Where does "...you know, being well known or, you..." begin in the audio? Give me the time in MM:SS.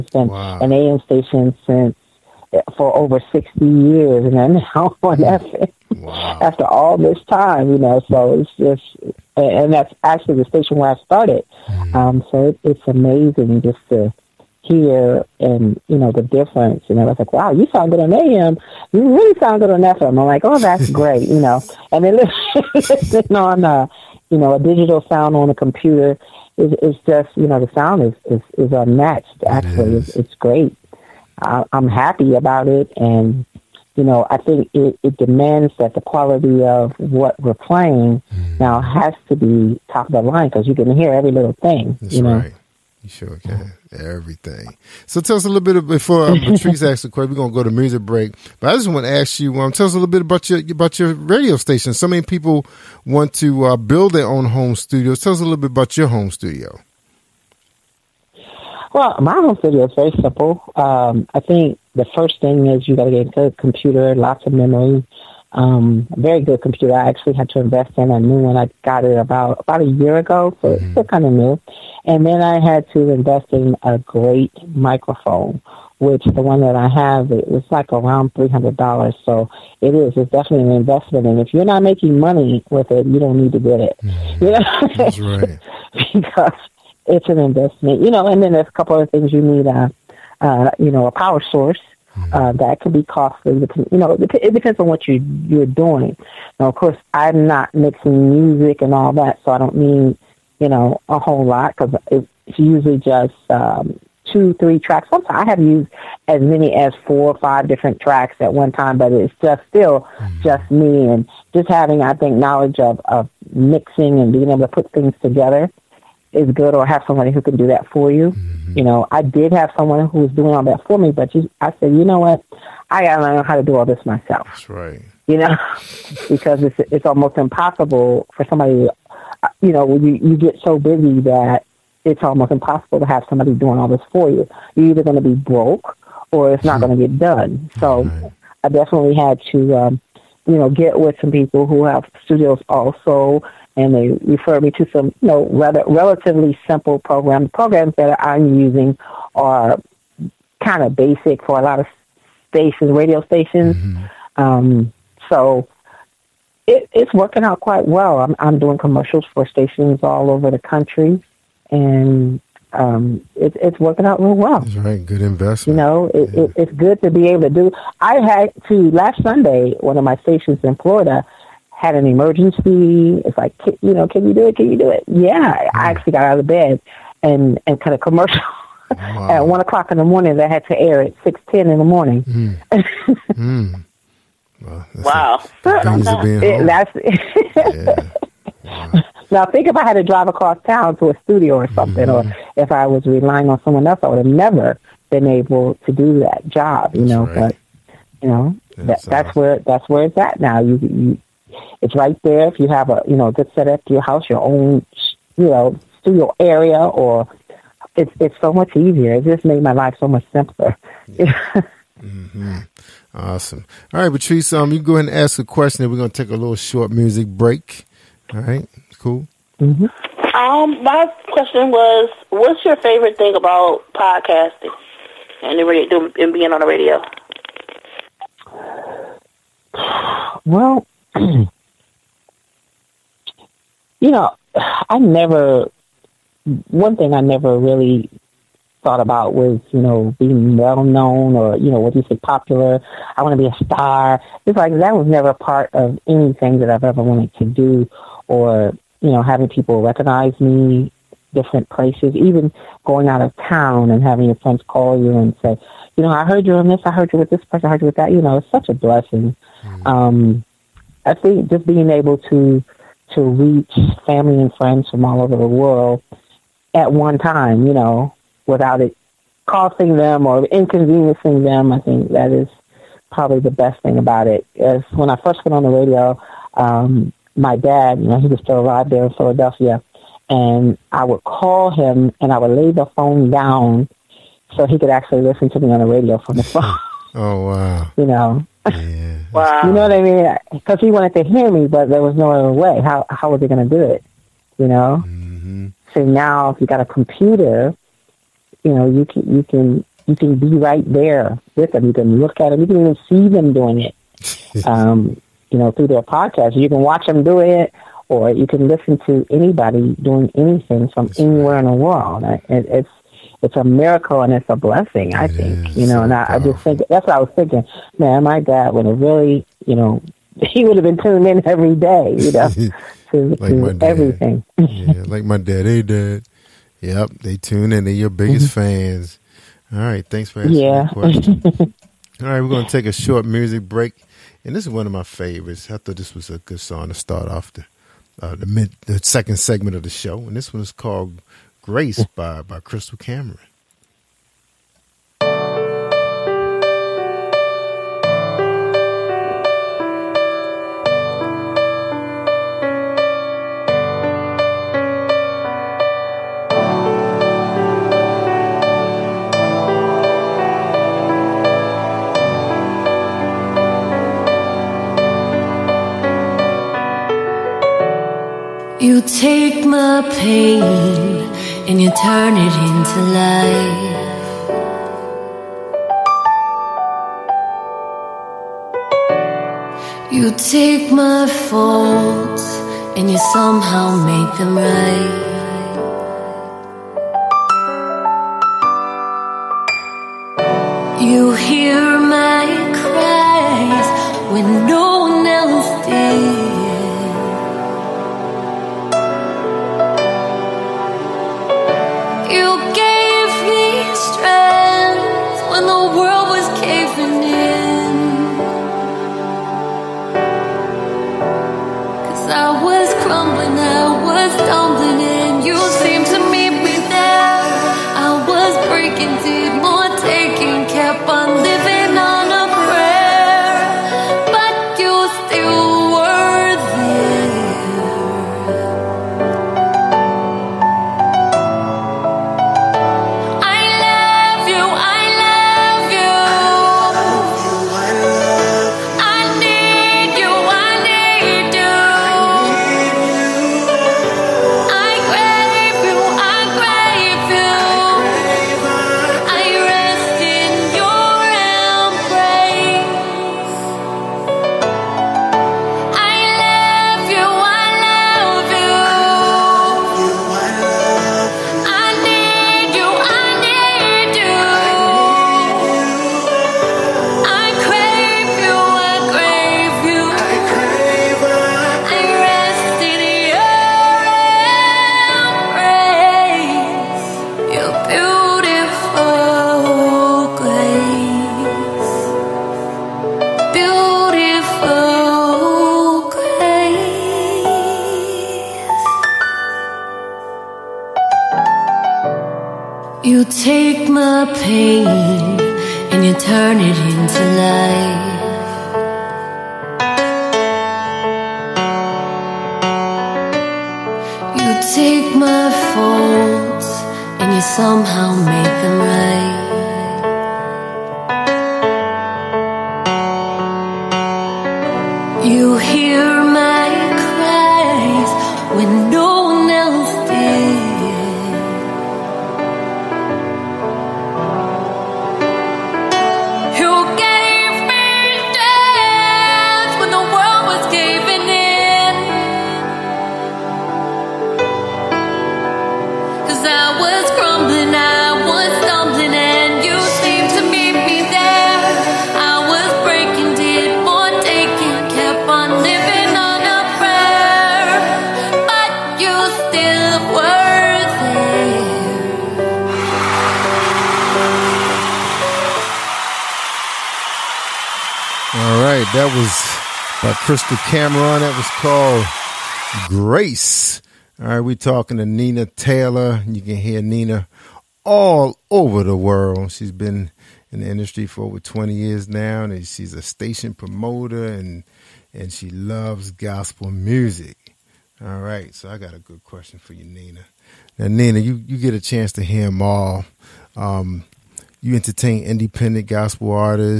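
03:59.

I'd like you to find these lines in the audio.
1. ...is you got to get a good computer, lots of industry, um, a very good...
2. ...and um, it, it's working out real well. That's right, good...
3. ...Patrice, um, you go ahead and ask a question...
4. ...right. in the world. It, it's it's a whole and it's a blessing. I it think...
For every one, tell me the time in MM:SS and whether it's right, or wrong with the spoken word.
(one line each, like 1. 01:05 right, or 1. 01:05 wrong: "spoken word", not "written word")
1. 01:02 wrong: "memory", not "industry"
2. 02:41 right
3. 03:34 right
4. 05:11 wrong: "miracle", not "whole".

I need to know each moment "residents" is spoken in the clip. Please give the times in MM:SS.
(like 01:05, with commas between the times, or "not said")
not said.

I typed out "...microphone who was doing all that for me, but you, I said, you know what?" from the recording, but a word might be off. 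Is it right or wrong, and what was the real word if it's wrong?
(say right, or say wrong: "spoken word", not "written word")
wrong: "someone", not "microphone".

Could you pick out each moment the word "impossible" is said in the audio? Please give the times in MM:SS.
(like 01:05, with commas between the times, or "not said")
02:07, 02:12.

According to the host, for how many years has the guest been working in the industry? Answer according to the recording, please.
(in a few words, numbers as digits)
20 years.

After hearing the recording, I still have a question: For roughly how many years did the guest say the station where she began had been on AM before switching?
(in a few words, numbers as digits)
60 years.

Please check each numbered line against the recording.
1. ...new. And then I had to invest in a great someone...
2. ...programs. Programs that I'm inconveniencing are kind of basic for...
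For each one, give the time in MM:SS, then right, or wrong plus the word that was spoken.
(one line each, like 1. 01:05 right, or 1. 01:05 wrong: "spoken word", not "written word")
1. 01:11 wrong: "microphone", not "someone"
2. 02:26 wrong: "using", not "inconveniencing".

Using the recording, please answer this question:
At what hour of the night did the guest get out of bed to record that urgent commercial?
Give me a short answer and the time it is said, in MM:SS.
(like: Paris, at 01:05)
1 o'clock, at 02:59.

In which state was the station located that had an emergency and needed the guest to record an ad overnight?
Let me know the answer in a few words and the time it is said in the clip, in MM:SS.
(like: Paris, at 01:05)
Florida, at 02:50.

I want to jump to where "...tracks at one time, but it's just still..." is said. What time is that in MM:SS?
01:47.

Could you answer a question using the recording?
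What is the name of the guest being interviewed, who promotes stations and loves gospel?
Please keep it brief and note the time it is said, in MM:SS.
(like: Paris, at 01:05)
Nina Taylor, at 09:25.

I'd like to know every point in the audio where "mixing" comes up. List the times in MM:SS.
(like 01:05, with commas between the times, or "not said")
01:37, 01:53.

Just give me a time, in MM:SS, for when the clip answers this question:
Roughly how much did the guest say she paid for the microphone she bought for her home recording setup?
01:18.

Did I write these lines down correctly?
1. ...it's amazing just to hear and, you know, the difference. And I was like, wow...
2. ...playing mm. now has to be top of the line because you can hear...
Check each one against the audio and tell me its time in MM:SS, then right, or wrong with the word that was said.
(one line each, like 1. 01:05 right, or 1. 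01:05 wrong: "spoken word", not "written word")
1. 00:12 right
2. 00:37 right.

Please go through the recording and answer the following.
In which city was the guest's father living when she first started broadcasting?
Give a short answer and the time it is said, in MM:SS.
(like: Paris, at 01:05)
Philadelphia, at 04:39.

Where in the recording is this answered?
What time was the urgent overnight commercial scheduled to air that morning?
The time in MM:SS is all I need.
03:01.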